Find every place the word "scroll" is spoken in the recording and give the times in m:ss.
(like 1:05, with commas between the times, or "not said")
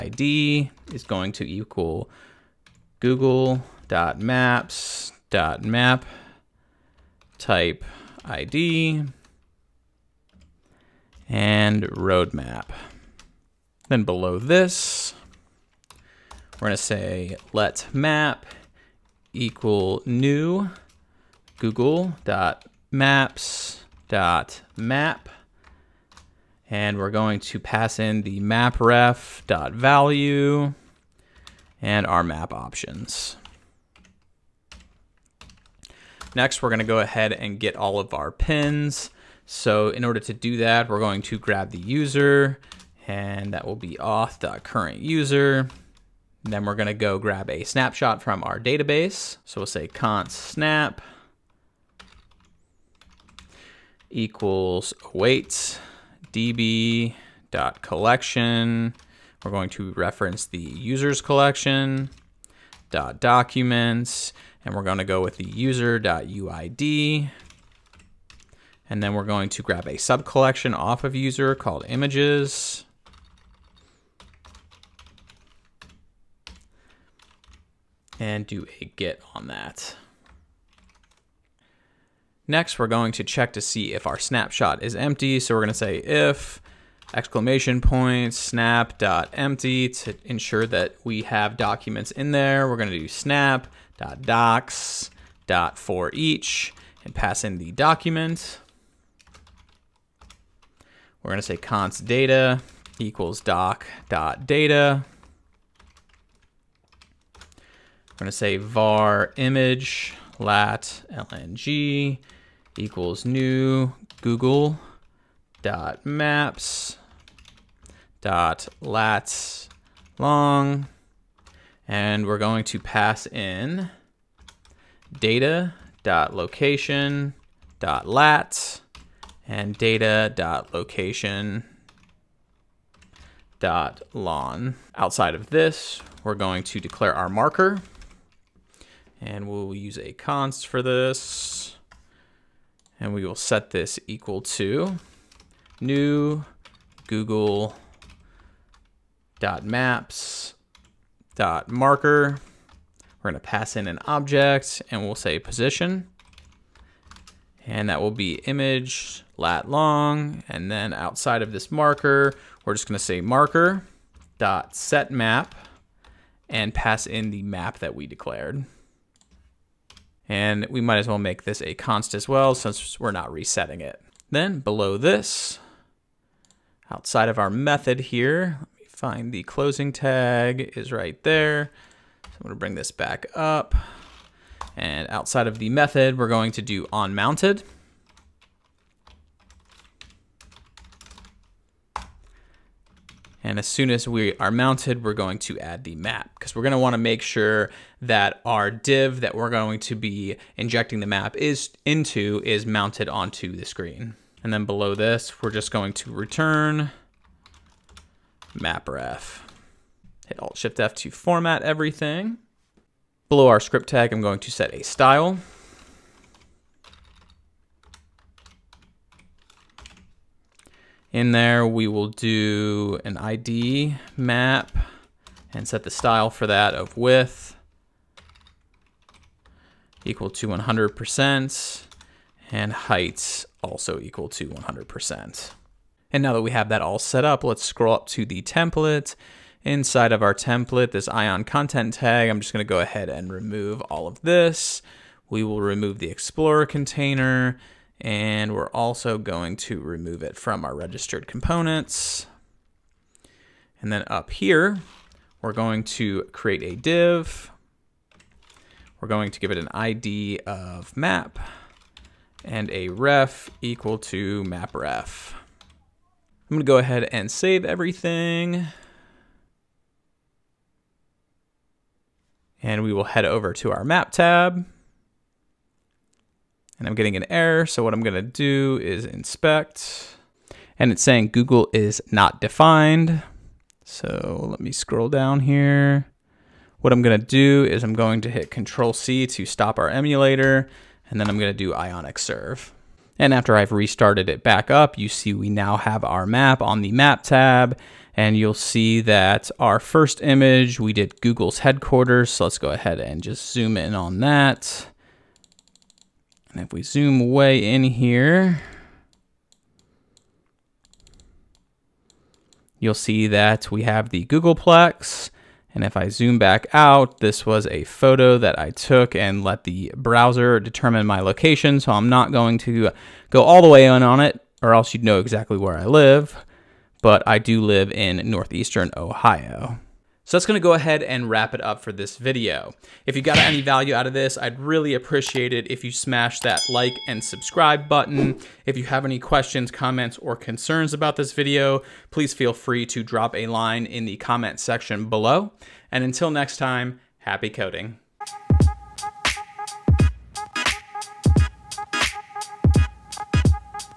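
3:57, 4:44.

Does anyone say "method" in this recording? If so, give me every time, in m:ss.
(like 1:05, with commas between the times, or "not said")
2:57, 3:05.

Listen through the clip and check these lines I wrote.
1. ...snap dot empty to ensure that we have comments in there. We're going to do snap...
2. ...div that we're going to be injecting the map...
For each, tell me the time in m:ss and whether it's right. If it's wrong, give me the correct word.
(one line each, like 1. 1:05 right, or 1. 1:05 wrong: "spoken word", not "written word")
1. 1:28 wrong: "documents", not "comments"
2. 3:18 right.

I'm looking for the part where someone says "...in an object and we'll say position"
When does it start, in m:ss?
2:33.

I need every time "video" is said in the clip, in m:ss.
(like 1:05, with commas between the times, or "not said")
5:32, 5:41.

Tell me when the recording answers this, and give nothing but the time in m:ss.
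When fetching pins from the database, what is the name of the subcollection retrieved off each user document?
1:11.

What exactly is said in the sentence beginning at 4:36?
And I'm getting an error, so what I'm gonna do is inspect.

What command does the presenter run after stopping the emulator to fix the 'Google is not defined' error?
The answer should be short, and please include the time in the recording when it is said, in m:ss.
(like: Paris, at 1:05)
Ionic Serve, at 4:51.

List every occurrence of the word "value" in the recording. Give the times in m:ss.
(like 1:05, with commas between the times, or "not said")
0:29, 5:33.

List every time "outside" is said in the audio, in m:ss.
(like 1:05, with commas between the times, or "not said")
2:14, 2:40, 2:56, 3:05.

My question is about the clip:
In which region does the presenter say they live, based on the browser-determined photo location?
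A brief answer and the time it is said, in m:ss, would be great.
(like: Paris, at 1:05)
Northeastern Ohio, at 5:28.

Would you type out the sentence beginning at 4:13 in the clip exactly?
And then up here, we're going to create a div.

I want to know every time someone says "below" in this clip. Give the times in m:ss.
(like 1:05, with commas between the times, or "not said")
0:14, 2:54, 3:24, 3:33, 5:45.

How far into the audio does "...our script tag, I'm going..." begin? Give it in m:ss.
3:33.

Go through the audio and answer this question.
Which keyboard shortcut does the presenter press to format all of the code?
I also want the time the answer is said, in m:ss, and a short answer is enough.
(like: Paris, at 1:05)
Alt Shift F, at 3:30.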